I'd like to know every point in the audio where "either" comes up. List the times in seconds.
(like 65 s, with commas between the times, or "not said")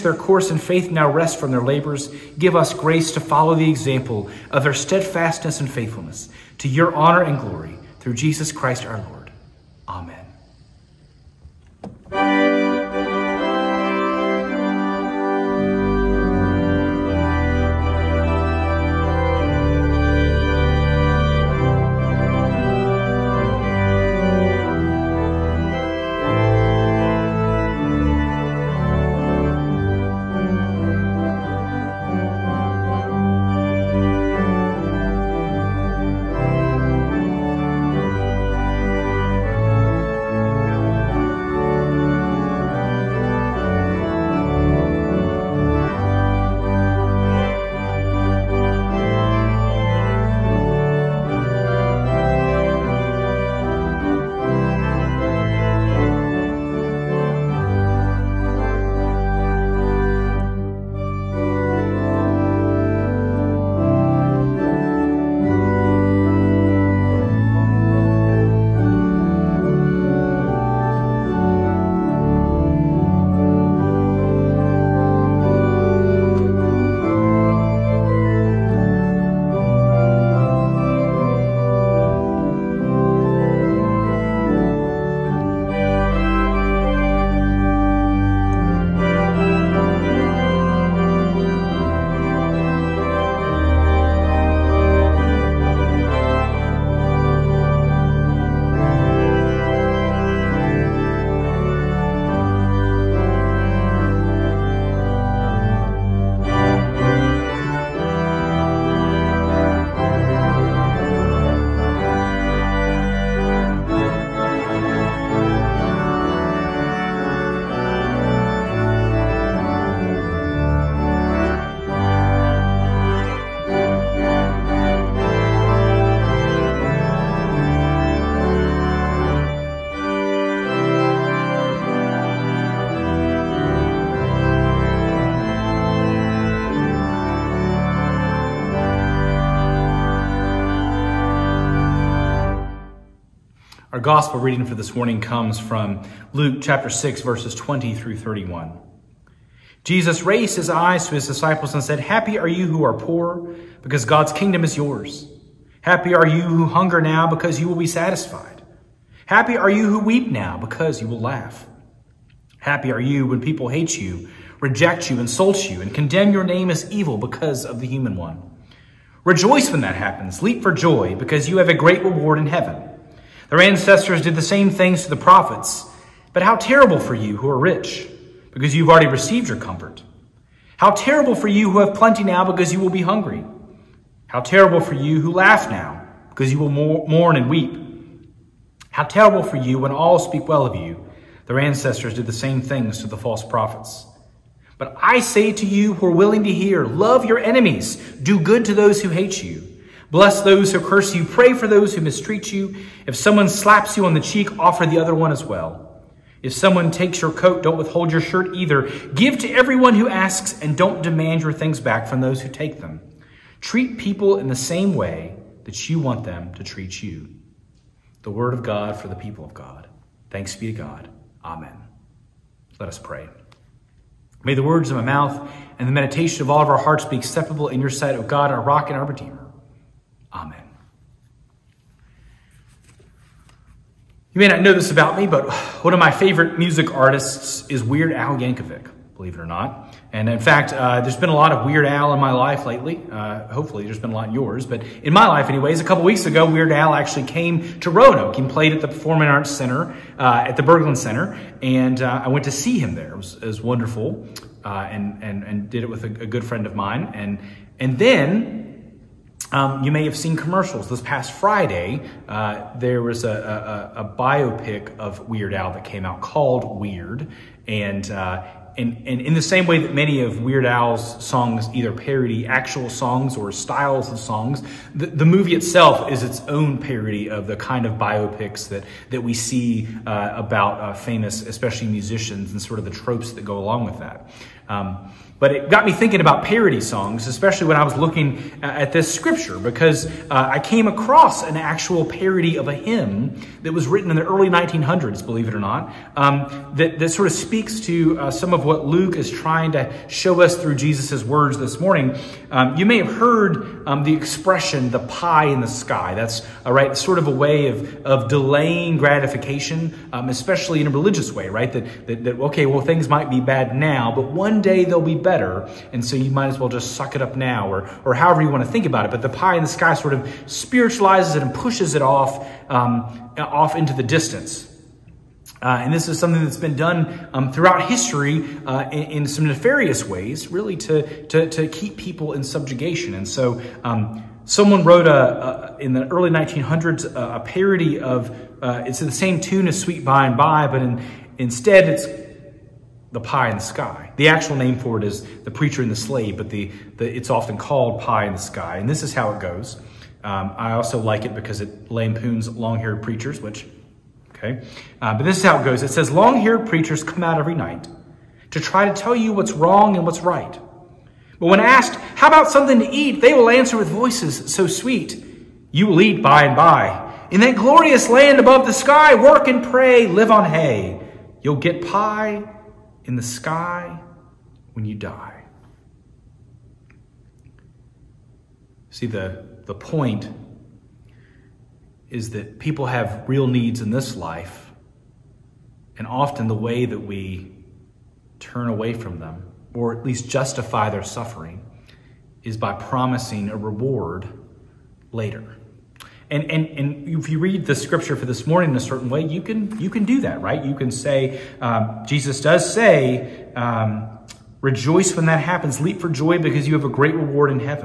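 208 s, 271 s.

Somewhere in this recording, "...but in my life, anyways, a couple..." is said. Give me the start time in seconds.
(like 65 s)
244 s.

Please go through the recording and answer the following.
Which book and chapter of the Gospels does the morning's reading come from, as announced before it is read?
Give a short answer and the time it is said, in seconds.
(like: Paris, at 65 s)
Luke 6, at 146 s.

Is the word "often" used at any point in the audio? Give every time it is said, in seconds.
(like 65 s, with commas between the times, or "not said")
347 s, 386 s.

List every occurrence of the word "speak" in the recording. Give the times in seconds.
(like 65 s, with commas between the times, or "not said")
190 s, 297 s.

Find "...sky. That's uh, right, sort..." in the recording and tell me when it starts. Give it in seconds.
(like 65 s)
305 s.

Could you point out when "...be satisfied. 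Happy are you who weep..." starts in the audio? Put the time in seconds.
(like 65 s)
157 s.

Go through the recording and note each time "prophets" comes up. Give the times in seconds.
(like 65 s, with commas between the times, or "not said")
175 s, 193 s.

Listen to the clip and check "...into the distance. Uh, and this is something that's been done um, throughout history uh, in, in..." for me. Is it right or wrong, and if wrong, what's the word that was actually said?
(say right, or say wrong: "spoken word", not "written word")
right.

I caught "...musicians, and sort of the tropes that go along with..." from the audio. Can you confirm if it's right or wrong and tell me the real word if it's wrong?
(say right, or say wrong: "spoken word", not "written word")
right.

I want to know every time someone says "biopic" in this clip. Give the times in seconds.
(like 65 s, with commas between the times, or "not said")
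264 s, 277 s.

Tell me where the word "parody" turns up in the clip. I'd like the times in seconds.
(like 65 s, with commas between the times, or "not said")
271 s, 276 s, 286 s, 292 s, 337 s.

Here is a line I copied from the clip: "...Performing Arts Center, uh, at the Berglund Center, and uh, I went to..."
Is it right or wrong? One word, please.
right.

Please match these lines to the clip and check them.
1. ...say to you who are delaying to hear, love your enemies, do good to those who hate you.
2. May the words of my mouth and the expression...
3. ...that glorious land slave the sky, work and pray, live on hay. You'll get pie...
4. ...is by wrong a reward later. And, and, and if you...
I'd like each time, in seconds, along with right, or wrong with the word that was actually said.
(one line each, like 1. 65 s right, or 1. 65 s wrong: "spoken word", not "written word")
1. 195 s wrong: "willing", not "delaying"
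2. 224 s wrong: "meditation", not "expression"
3. 367 s wrong: "above", not "slave"
4. 392 s wrong: "promising", not "wrong".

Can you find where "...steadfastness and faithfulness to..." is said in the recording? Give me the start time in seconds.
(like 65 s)
4 s.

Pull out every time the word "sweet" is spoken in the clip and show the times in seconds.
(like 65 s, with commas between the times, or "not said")
339 s, 364 s.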